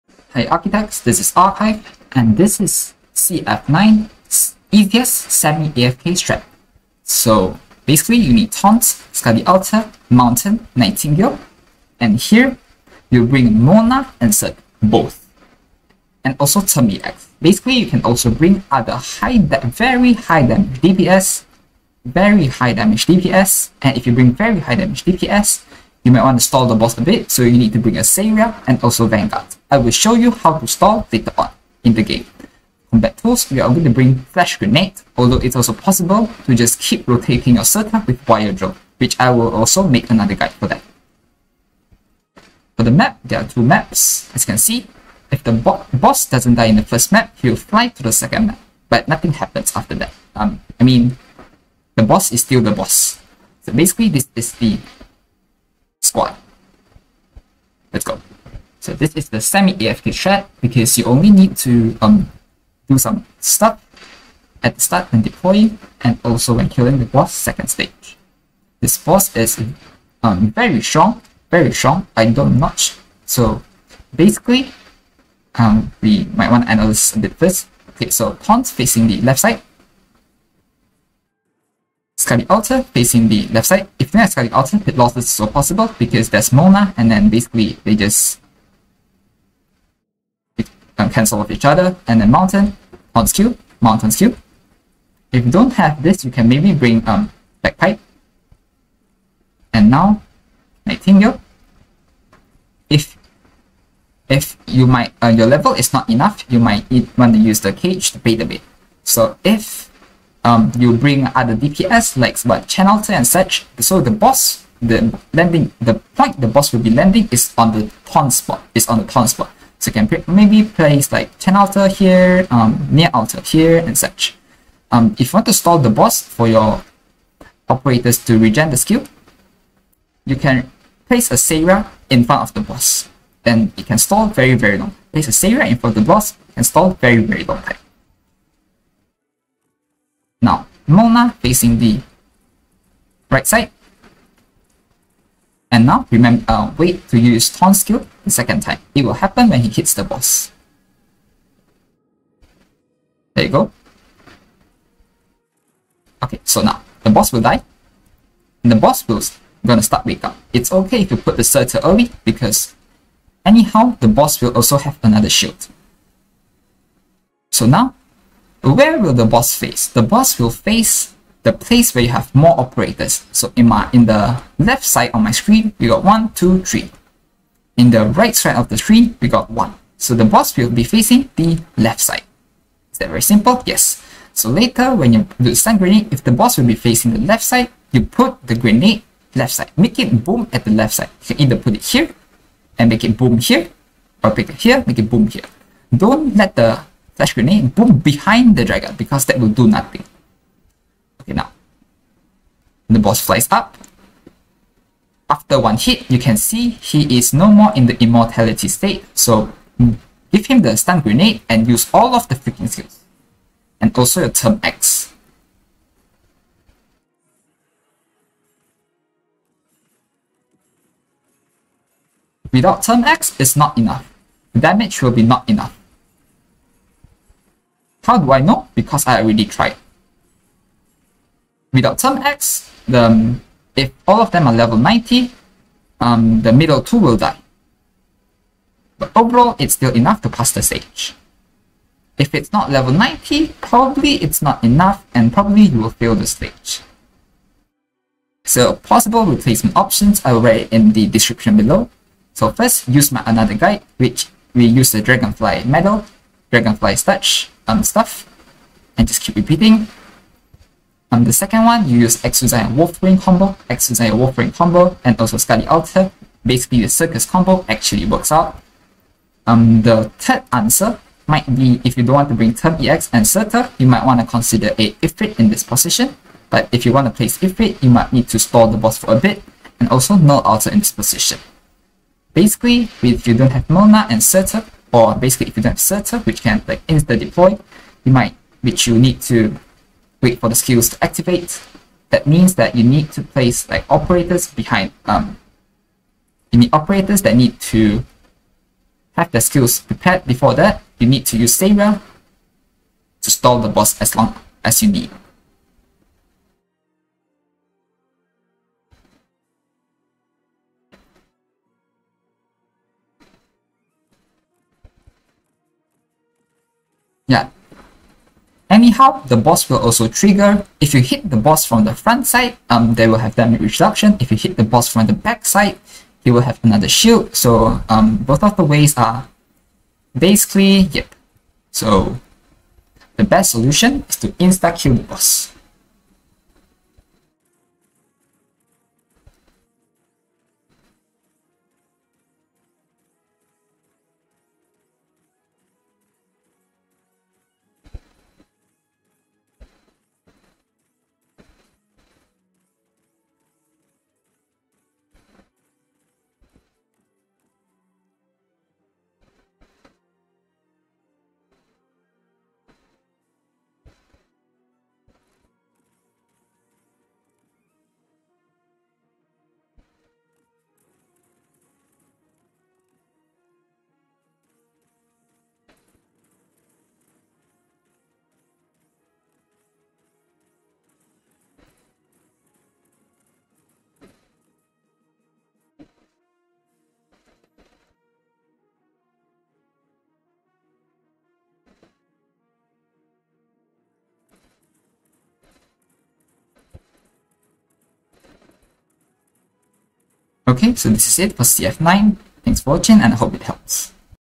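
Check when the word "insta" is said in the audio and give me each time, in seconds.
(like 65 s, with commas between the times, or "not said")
286 s, 334 s.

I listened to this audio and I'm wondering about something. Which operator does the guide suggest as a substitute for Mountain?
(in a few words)
Bagpipe.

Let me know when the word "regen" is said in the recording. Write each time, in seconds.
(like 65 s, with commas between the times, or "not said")
128 s.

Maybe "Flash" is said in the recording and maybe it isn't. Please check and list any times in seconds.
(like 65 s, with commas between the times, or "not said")
34 s, 197 s.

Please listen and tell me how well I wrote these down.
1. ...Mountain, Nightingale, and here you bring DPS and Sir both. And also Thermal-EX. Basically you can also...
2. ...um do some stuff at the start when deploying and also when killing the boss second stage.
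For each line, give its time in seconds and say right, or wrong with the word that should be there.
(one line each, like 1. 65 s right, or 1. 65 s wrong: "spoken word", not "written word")
1. 10 s wrong: "Mona", not "DPS"
2. 62 s right.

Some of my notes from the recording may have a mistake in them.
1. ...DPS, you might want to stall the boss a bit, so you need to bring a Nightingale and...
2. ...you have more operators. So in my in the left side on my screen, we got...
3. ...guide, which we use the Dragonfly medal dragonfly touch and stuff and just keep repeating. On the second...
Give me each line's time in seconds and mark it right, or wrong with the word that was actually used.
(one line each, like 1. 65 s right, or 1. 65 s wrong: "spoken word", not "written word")
1. 25 s wrong: "Seiya", not "Nightingale"
2. 172 s right
3. 253 s right.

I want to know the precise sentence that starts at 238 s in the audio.
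But overall, it's still enough to pass the stage.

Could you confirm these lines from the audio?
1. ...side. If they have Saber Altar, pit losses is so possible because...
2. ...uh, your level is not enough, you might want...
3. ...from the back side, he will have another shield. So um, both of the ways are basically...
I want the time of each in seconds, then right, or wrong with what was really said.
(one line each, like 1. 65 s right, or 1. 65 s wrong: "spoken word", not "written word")
1. 83 s wrong: "Excalic", not "Saber"
2. 105 s right
3. 324 s right.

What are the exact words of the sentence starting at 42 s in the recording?
For the map, there are two maps.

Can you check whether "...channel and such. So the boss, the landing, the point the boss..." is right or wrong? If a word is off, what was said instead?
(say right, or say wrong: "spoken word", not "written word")
right.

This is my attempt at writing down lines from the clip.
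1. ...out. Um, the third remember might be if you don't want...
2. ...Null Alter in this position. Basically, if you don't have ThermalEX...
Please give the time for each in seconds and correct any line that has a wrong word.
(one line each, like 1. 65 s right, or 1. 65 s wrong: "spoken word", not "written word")
1. 268 s wrong: "answer", not "remember"
2. 280 s wrong: "Mona", not "ThermalEX".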